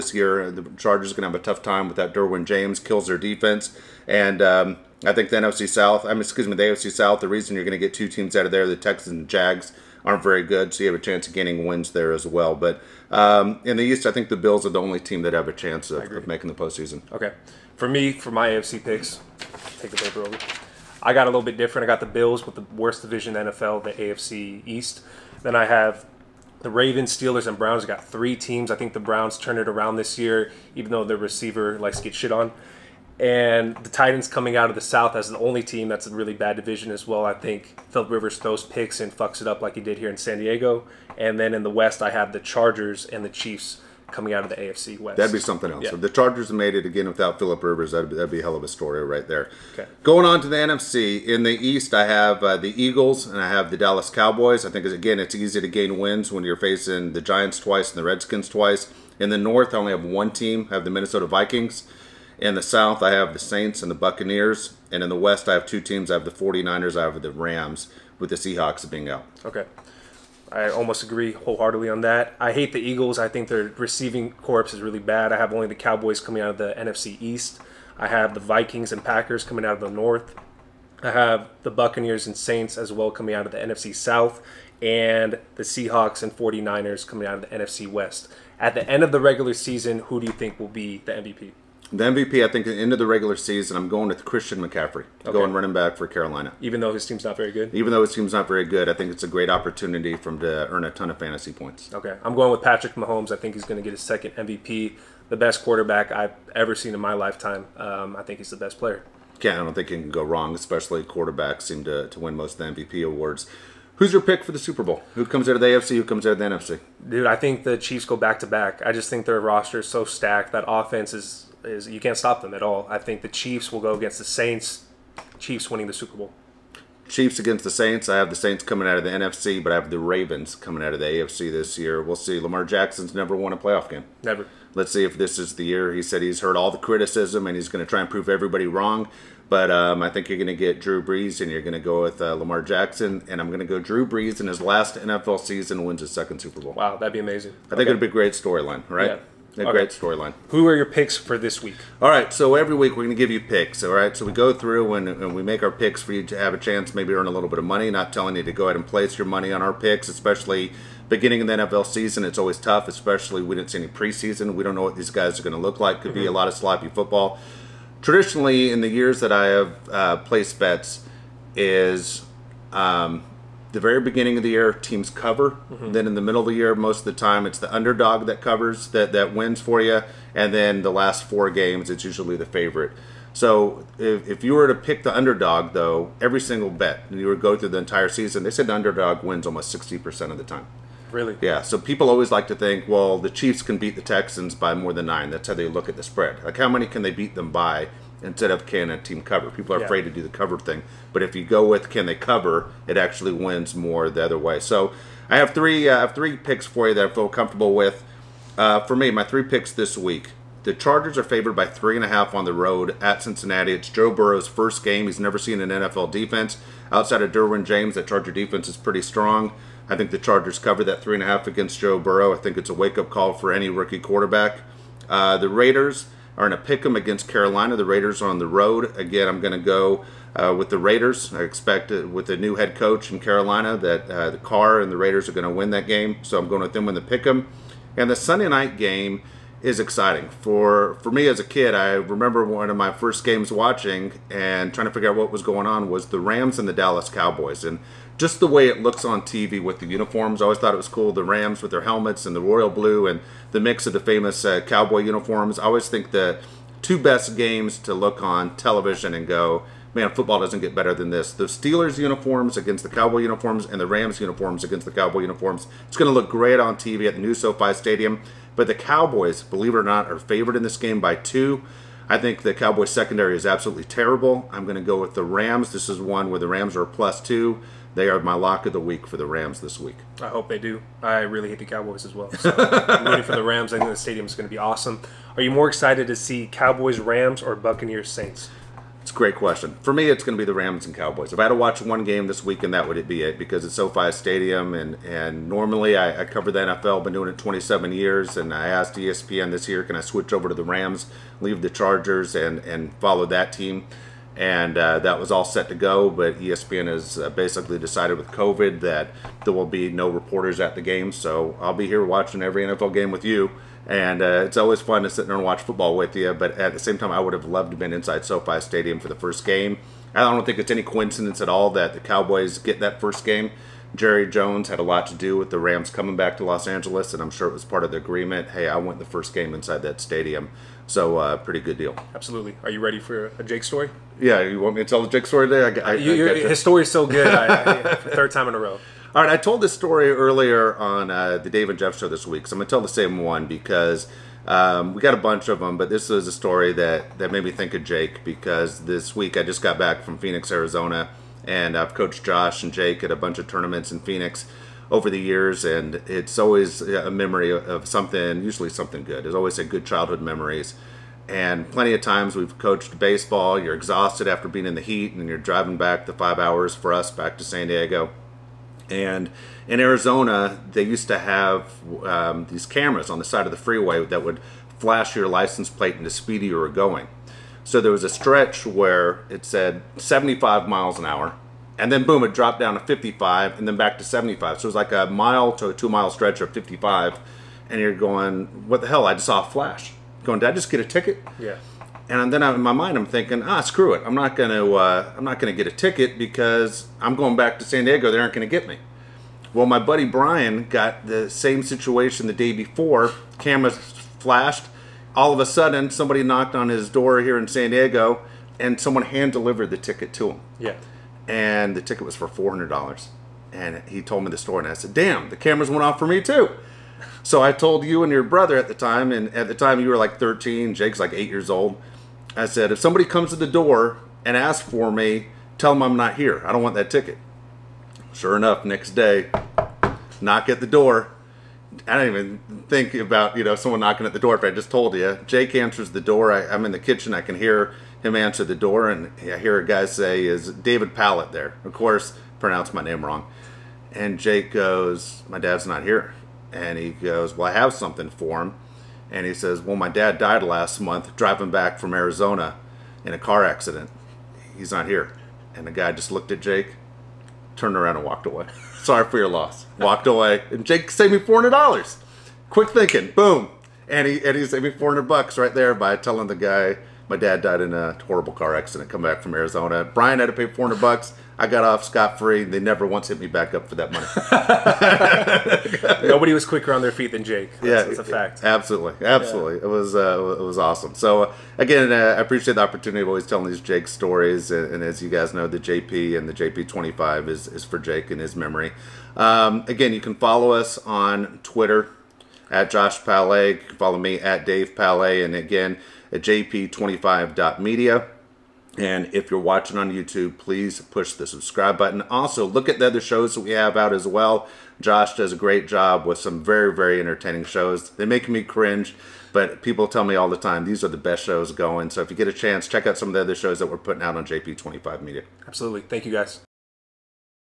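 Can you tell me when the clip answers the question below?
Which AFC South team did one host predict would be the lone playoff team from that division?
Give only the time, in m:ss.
0:33.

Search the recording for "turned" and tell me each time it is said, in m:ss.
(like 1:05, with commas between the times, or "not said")
0:29, 7:37.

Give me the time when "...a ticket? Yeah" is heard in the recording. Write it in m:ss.
6:30.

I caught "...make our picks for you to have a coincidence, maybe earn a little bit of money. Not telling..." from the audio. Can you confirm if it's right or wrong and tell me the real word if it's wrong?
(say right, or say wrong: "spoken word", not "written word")
wrong: "chance", not "coincidence".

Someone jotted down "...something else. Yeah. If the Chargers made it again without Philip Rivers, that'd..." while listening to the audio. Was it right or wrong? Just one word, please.
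right.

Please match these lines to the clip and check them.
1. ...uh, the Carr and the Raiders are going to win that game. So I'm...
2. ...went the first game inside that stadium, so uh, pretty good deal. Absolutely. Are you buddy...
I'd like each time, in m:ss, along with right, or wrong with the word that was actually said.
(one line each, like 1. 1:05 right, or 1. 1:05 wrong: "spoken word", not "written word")
1. 3:54 right
2. 5:28 wrong: "ready", not "buddy".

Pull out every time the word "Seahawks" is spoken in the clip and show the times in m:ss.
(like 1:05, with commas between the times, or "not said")
1:08, 1:25.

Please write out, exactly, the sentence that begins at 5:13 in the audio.
And uh, it's always fun to sit there and watch football with you.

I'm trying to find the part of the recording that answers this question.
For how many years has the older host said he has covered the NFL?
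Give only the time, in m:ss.
4:57.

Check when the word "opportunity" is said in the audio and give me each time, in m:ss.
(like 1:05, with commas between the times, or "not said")
1:39, 8:02.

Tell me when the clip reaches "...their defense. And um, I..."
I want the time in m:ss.
0:03.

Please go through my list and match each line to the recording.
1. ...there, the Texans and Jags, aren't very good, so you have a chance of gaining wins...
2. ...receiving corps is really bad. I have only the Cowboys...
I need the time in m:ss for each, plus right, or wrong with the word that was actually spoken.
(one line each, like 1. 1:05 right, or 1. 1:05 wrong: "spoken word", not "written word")
1. 0:08 right
2. 1:13 right.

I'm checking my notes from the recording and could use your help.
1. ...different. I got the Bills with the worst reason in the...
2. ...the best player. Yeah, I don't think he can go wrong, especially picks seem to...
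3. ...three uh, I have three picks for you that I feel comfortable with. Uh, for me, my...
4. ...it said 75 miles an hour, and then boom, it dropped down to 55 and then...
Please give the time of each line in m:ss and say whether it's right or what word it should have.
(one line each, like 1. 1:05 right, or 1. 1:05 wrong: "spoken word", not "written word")
1. 0:21 wrong: "division", not "reason"
2. 1:48 wrong: "quarterbacks", not "picks"
3. 3:25 right
4. 6:19 right.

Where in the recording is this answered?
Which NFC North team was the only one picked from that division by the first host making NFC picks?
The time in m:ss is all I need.
1:00.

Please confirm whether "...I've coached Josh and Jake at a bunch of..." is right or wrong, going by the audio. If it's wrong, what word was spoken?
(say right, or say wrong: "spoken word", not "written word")
right.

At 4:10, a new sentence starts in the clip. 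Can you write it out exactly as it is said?
I always thought it was cool.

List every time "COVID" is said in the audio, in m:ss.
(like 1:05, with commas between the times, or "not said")
5:08.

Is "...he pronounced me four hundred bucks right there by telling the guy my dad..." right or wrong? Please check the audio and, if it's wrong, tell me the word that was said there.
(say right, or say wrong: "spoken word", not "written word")
wrong: "saved", not "pronounced".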